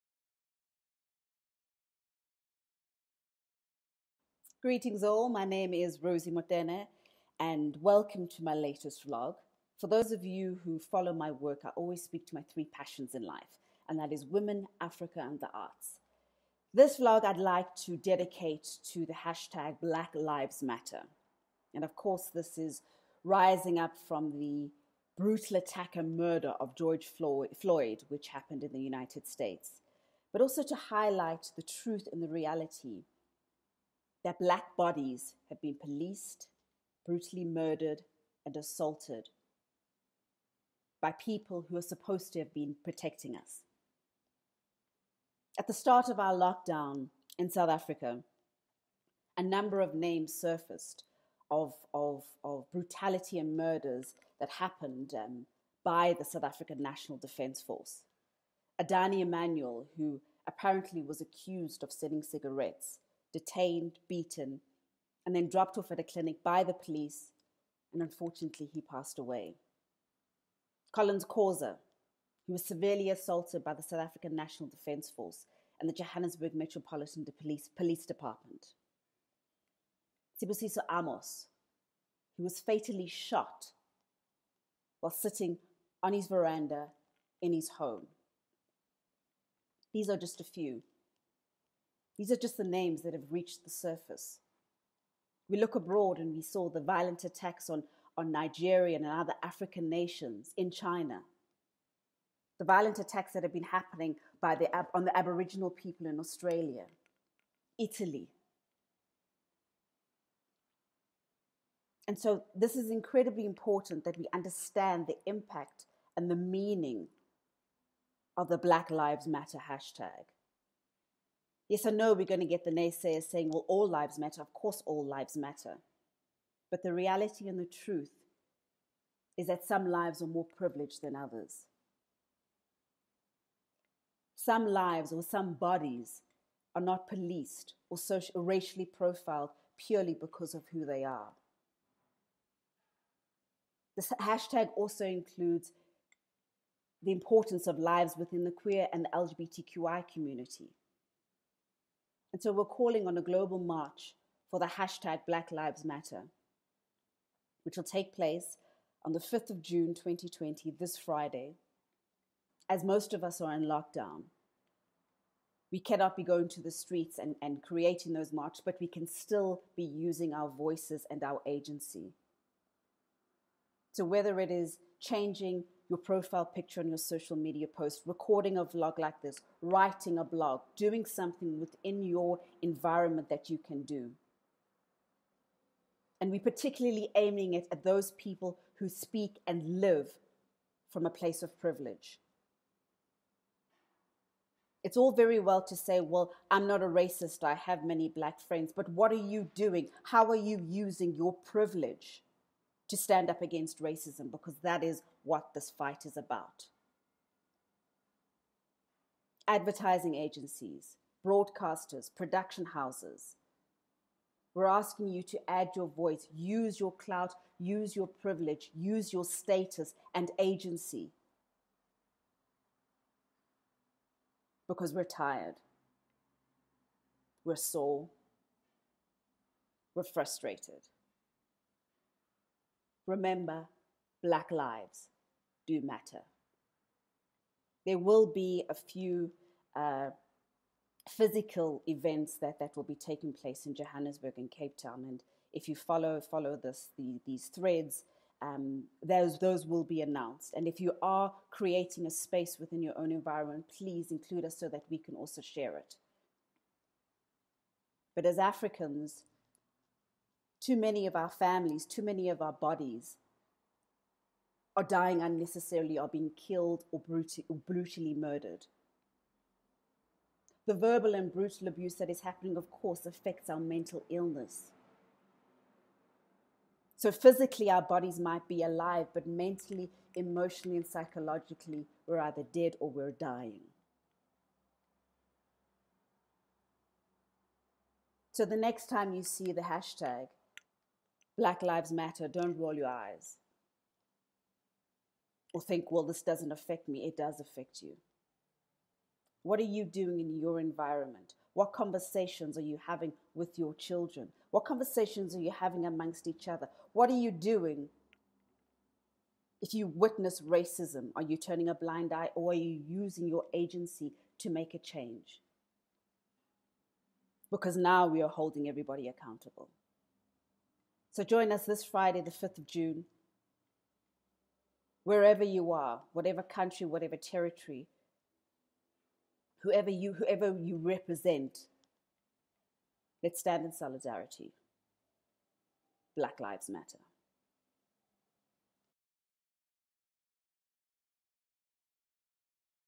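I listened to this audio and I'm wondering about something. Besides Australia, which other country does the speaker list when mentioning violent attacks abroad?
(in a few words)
Italy.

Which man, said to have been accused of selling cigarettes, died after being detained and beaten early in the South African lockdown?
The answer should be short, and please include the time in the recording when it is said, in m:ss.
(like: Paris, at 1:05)
Adani Emanuel, at 0:58.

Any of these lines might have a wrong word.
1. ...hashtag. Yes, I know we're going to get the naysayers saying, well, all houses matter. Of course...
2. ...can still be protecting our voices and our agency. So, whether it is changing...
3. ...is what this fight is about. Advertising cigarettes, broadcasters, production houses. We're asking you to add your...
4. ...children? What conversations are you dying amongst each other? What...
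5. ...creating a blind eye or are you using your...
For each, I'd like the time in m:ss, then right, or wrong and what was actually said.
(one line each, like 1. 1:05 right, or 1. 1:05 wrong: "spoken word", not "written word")
1. 1:59 wrong: "lives", not "houses"
2. 2:48 wrong: "using", not "protecting"
3. 3:24 wrong: "agencies", not "cigarettes"
4. 5:03 wrong: "having", not "dying"
5. 5:11 wrong: "turning", not "creating".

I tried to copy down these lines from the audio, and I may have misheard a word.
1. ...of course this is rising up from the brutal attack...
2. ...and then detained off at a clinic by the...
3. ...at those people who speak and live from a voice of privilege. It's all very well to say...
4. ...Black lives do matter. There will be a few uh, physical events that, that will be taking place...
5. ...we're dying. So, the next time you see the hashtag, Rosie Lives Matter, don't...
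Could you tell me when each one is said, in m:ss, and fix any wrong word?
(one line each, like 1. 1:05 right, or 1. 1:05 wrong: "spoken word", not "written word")
1. 0:21 right
2. 1:05 wrong: "dropped", not "detained"
3. 3:07 wrong: "place", not "voice"
4. 3:54 right
5. 4:42 wrong: "Black", not "Rosie".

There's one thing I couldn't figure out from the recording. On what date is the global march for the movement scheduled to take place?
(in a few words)
5 June 2020.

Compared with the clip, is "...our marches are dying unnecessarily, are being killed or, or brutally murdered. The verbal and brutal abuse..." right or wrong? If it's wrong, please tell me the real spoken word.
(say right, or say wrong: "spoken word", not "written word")
wrong: "bodies", not "marches".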